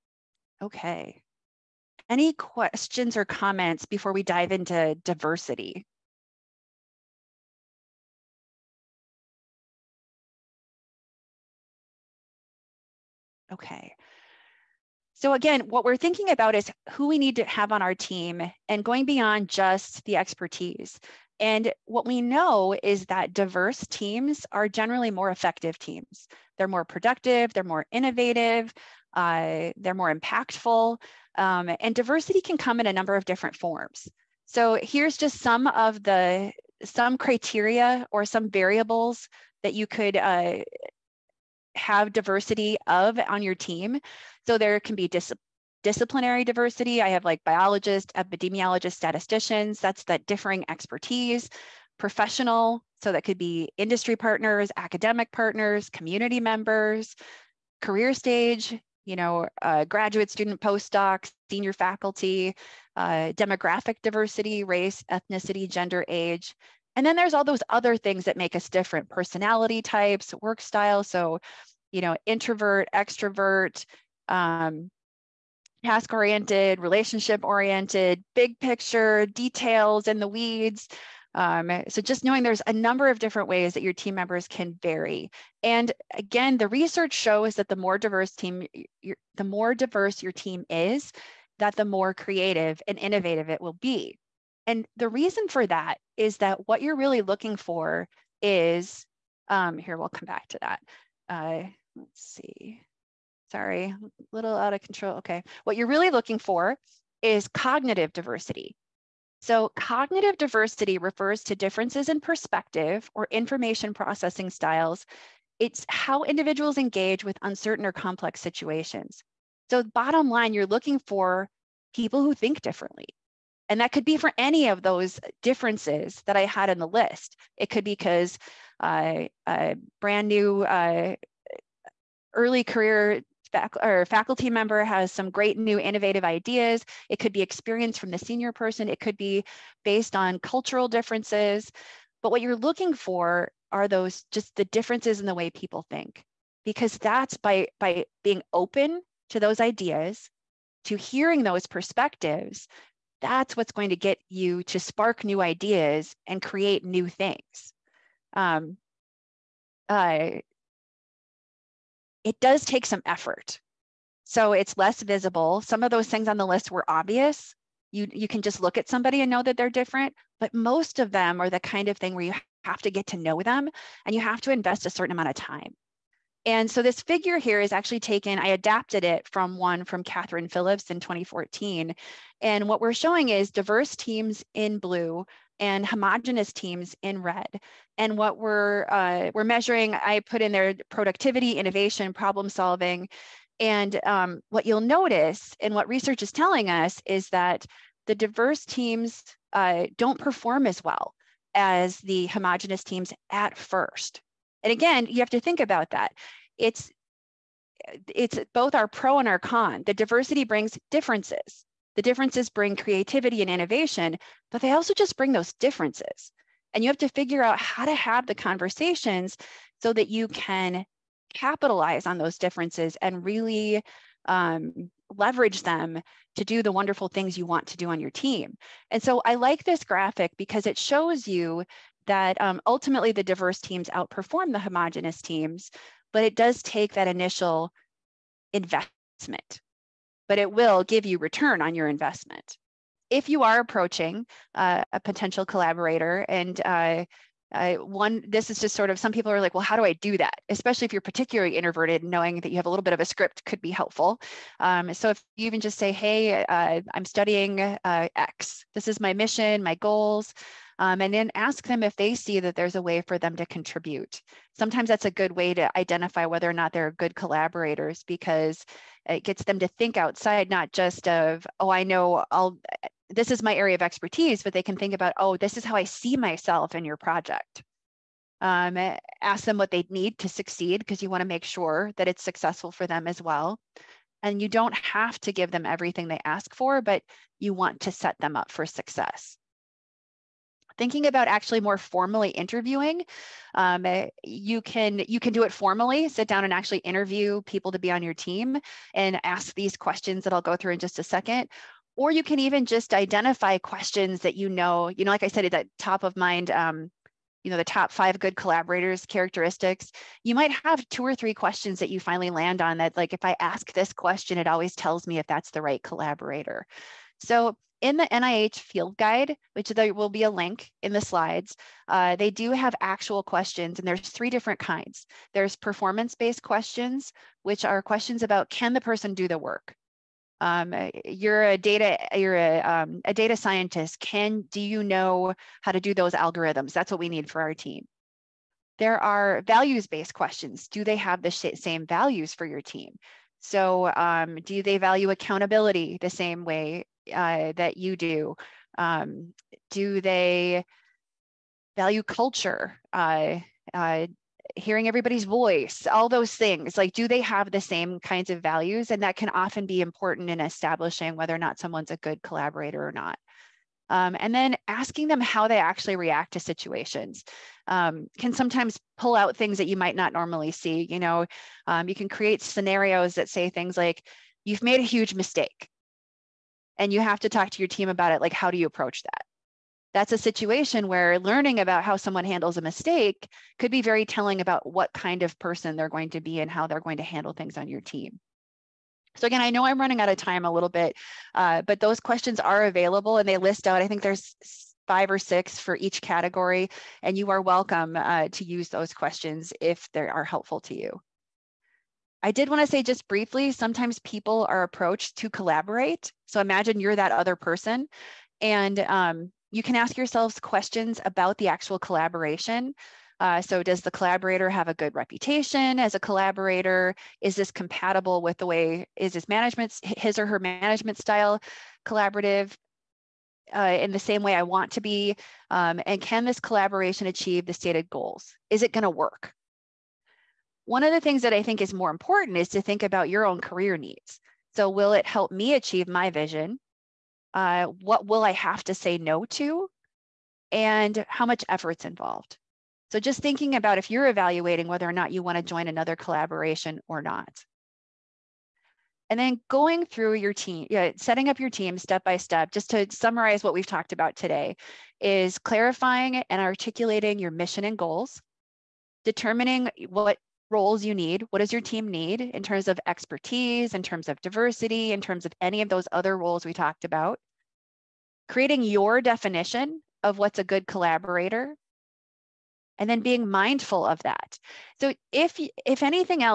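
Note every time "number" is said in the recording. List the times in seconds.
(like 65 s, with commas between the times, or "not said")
32 s, 82 s.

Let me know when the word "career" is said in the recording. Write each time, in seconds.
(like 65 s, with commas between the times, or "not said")
57 s, 132 s, 433 s.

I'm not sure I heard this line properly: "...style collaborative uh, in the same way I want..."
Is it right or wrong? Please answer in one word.
right.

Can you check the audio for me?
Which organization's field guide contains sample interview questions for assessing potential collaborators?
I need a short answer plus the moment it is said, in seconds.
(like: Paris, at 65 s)
NIH, at 318 s.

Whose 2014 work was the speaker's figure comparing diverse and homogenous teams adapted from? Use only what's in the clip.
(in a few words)
Katherine Phillips.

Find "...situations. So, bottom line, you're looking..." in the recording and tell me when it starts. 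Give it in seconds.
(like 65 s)
118 s.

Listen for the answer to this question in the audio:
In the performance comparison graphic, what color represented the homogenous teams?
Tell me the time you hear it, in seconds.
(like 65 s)
187 s.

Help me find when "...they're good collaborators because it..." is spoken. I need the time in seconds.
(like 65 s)
266 s.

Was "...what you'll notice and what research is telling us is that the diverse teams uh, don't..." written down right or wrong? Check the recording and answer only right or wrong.
right.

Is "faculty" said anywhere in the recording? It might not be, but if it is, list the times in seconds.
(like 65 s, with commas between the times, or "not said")
61 s, 134 s.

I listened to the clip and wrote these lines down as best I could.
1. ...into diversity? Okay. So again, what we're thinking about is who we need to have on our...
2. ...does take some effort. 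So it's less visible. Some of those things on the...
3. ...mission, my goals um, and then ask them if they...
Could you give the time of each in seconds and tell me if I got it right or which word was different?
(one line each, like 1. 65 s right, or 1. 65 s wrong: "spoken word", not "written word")
1. 4 s right
2. 162 s right
3. 259 s right.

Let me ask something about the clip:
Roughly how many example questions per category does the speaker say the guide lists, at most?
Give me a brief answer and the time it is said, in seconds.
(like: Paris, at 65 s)
6, at 395 s.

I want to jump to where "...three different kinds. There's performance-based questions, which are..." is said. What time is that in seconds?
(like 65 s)
323 s.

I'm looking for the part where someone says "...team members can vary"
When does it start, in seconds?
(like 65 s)
83 s.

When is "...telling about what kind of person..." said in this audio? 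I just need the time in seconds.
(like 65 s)
384 s.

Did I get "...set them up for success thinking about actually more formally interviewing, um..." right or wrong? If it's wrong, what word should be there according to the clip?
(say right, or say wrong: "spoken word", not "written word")
right.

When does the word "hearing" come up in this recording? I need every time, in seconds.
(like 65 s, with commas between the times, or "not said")
150 s, 354 s.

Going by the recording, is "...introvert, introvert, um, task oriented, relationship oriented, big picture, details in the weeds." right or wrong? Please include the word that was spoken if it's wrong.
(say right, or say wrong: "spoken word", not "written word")
wrong: "extrovert", not "introvert".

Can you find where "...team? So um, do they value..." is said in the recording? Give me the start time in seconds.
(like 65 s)
342 s.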